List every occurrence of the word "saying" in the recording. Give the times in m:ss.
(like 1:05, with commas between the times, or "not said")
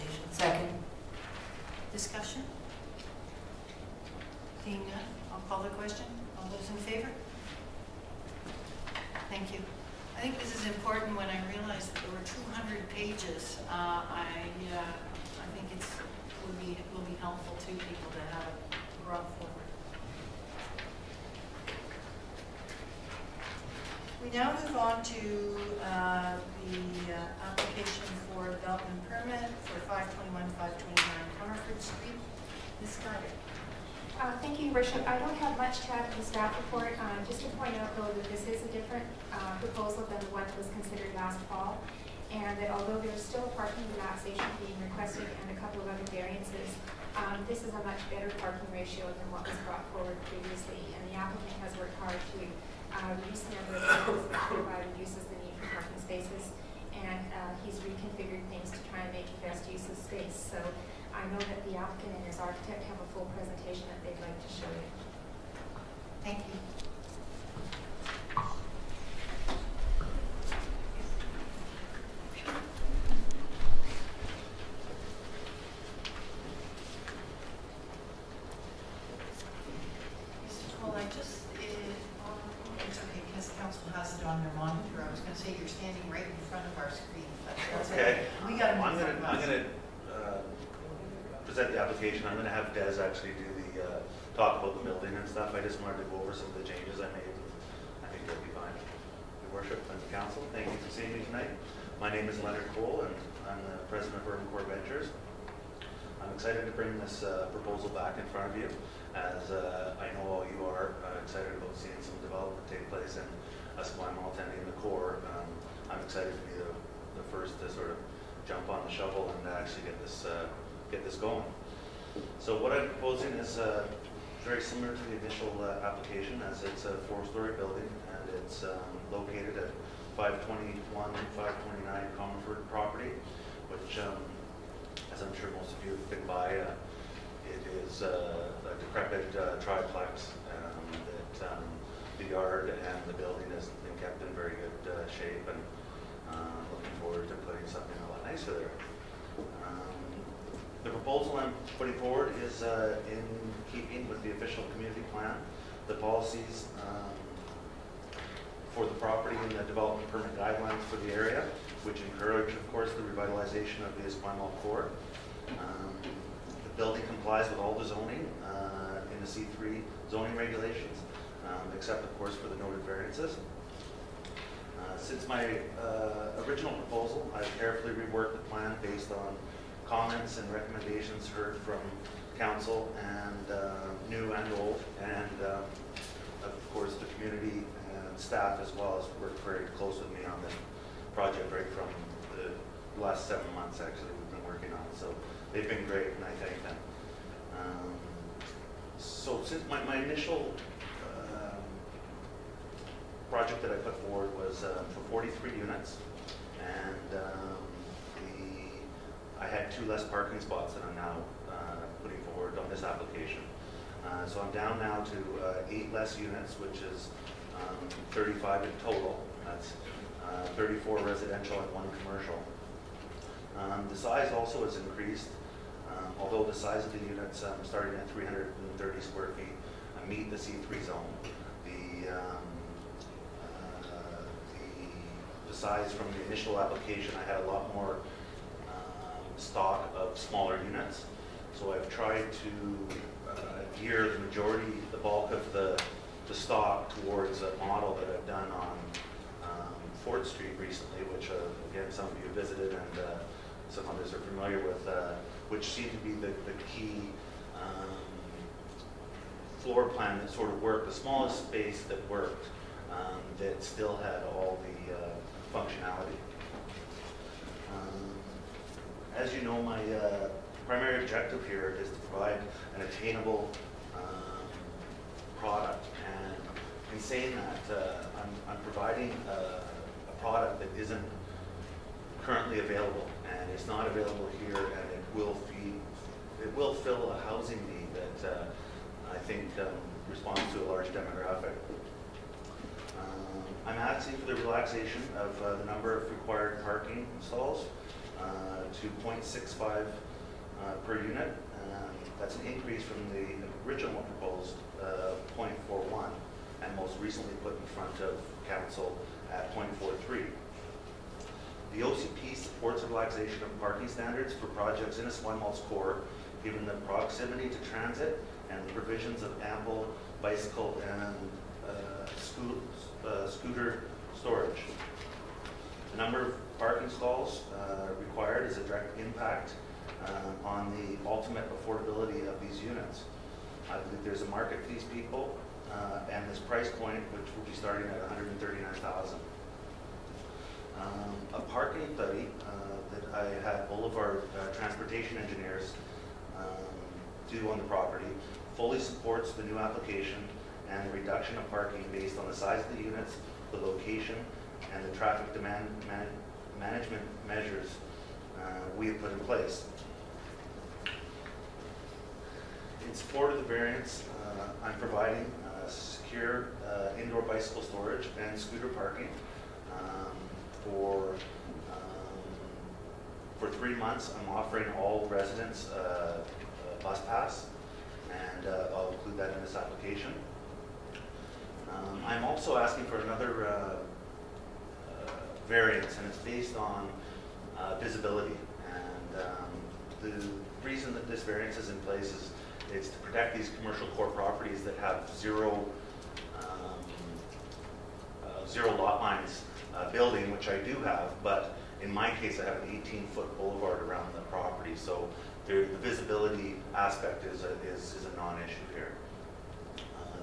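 4:37.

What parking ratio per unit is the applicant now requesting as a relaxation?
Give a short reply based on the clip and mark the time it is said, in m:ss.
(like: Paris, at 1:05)
0.65, at 4:59.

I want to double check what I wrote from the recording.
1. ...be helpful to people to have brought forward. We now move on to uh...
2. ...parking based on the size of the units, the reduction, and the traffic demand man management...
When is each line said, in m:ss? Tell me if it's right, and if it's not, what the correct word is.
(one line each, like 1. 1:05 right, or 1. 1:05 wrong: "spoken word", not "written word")
1. 0:17 right
2. 5:51 wrong: "location", not "reduction".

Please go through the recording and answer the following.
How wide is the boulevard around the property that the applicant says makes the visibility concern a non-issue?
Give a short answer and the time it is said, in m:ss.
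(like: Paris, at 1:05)
18 feet, at 6:42.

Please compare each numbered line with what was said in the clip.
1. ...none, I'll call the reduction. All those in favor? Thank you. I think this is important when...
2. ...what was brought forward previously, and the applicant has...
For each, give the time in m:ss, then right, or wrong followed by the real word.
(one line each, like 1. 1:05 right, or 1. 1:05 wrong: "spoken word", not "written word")
1. 0:04 wrong: "question", not "reduction"
2. 0:49 right.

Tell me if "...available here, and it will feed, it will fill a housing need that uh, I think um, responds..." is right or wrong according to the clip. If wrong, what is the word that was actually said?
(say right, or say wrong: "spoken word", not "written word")
right.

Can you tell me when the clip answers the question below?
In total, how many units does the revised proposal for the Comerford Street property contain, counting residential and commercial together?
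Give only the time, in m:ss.
3:38.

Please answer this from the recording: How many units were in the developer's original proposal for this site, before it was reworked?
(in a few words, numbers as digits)
43.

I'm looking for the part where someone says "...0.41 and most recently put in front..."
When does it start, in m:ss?
5:05.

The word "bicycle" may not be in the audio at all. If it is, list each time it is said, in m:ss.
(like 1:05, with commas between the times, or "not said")
5:20, 6:07.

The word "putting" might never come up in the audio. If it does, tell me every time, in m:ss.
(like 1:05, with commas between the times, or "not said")
2:27, 2:31, 3:32.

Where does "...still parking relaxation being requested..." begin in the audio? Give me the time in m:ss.
0:43.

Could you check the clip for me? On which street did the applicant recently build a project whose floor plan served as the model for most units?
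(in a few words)
Fort Street.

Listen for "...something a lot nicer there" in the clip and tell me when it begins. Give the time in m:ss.
2:27.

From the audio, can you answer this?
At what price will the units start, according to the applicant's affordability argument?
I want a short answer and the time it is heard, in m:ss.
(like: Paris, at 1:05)
$139,000, at 5:38.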